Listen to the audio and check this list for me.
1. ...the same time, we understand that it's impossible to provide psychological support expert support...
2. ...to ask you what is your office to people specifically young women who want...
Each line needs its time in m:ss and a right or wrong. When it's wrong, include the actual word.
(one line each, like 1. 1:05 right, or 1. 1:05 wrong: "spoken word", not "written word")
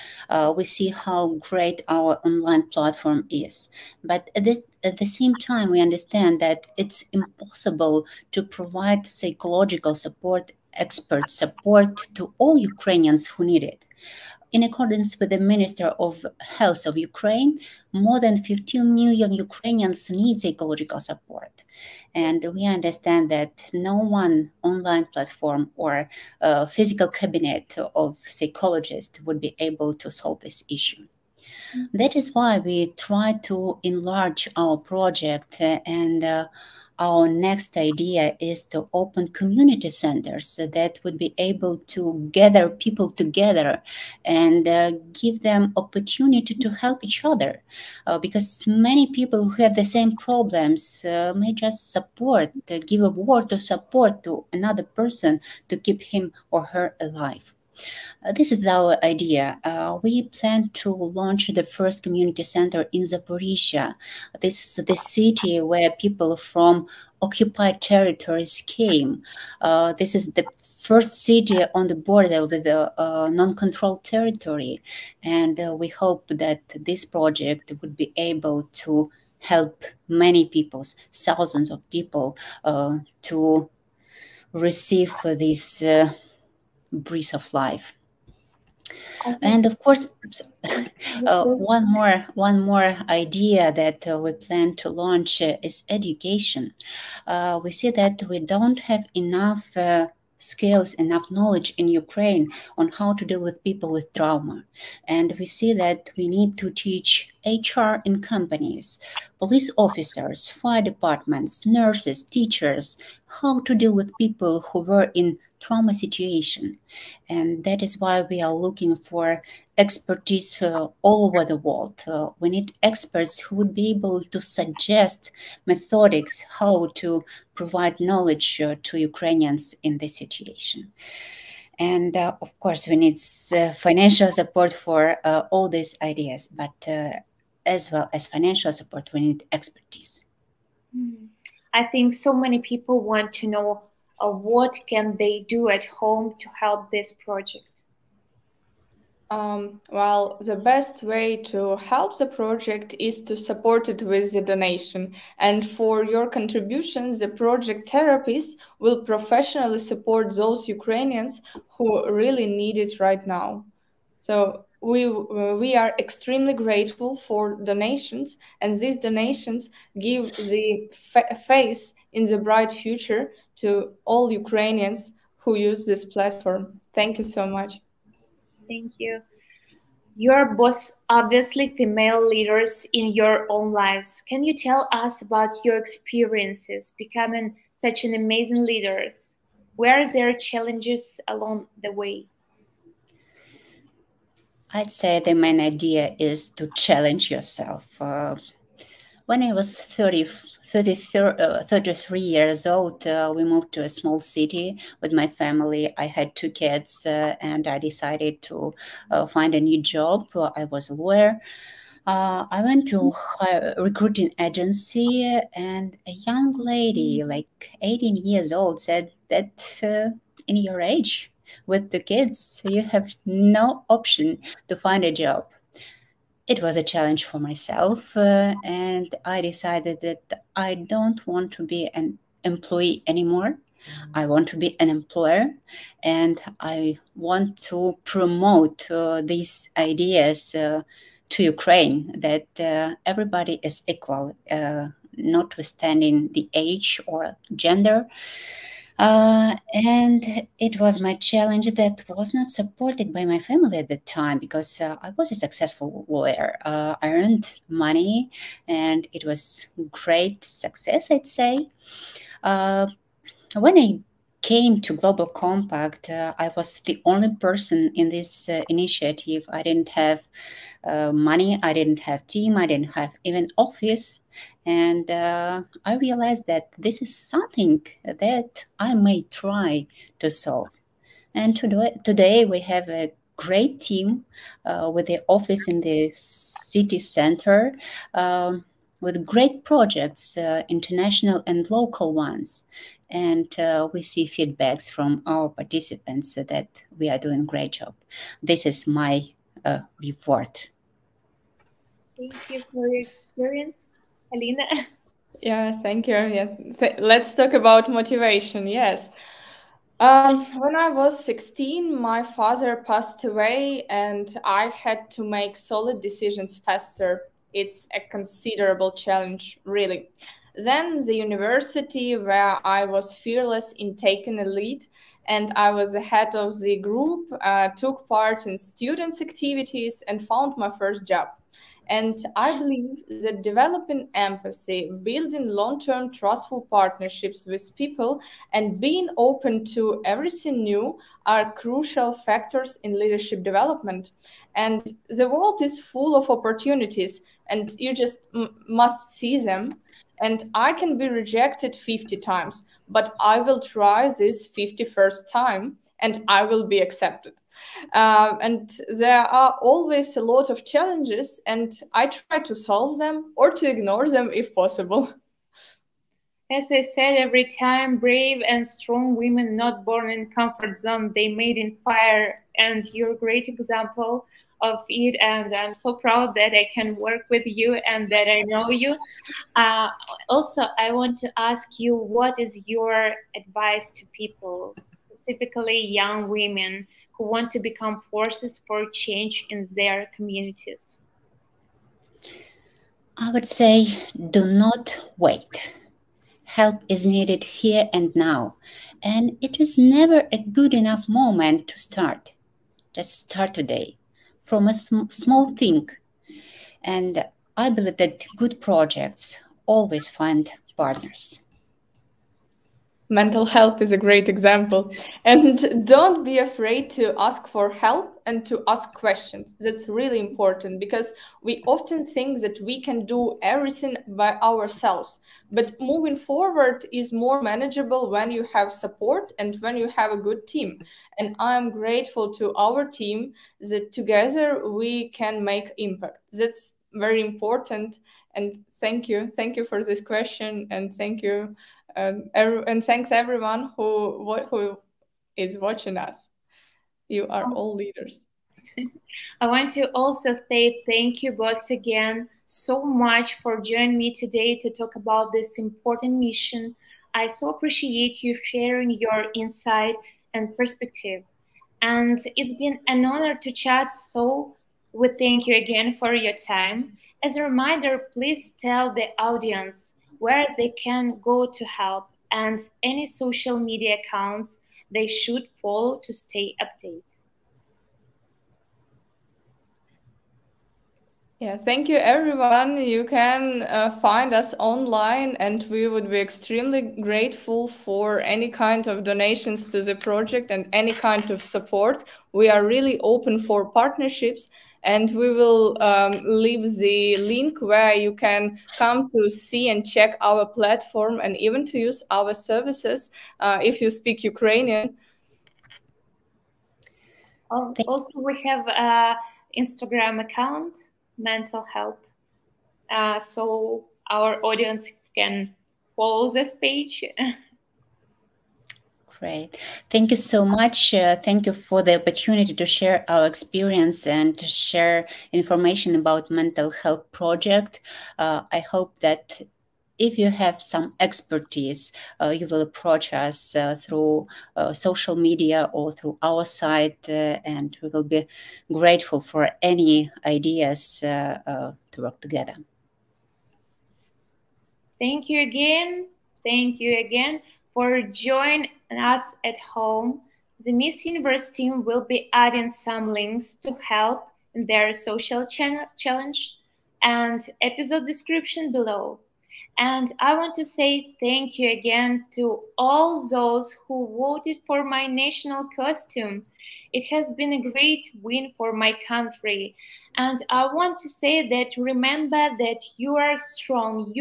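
1. 0:04 right
2. 6:21 wrong: "advice", not "office".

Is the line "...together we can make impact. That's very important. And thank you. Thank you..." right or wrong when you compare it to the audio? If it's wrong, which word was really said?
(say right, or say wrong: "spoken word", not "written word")
right.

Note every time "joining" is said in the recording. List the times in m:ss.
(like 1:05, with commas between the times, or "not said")
7:33, 9:08.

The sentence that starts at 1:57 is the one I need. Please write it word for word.
And that is why we are looking for expertise uh, all over the world.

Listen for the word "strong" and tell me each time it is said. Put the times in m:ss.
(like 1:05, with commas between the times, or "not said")
6:08, 9:33.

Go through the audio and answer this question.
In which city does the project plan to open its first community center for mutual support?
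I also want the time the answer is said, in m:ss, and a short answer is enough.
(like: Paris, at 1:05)
Zaporizhia, at 1:03.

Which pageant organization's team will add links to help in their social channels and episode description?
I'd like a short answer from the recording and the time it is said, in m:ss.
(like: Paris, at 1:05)
Miss Universe, at 9:10.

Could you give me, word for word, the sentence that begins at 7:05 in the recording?
But moving forward is more manageable when you have support and when you have a good team.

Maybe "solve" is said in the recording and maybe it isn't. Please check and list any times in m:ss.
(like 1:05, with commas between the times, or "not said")
0:30, 4:40, 6:02.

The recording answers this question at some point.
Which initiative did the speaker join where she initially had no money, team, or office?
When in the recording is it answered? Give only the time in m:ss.
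4:24.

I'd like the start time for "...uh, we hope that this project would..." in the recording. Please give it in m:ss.
1:15.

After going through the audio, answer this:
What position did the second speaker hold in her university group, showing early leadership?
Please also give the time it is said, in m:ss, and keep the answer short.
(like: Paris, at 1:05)
head of the group, at 5:25.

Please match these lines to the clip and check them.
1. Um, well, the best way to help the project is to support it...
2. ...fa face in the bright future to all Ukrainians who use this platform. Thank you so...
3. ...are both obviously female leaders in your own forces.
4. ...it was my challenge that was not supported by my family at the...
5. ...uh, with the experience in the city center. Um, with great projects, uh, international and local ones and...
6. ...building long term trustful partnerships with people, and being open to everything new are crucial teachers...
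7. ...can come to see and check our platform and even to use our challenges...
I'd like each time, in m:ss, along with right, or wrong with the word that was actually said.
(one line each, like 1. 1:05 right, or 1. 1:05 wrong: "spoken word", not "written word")
1. 2:29 right
2. 2:50 right
3. 3:00 wrong: "lives", not "forces"
4. 4:10 right
5. 4:44 wrong: "office", not "experience"
6. 5:35 wrong: "factors", not "teachers"
7. 8:18 wrong: "services", not "challenges".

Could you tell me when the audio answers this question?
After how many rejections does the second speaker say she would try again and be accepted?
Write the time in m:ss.
5:51.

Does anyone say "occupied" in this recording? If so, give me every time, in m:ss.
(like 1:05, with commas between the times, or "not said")
1:07.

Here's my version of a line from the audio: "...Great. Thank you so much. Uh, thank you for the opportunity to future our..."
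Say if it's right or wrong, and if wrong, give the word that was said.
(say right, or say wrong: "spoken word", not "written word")
wrong: "share", not "future".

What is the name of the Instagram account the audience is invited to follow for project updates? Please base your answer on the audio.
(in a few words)
Mental Help.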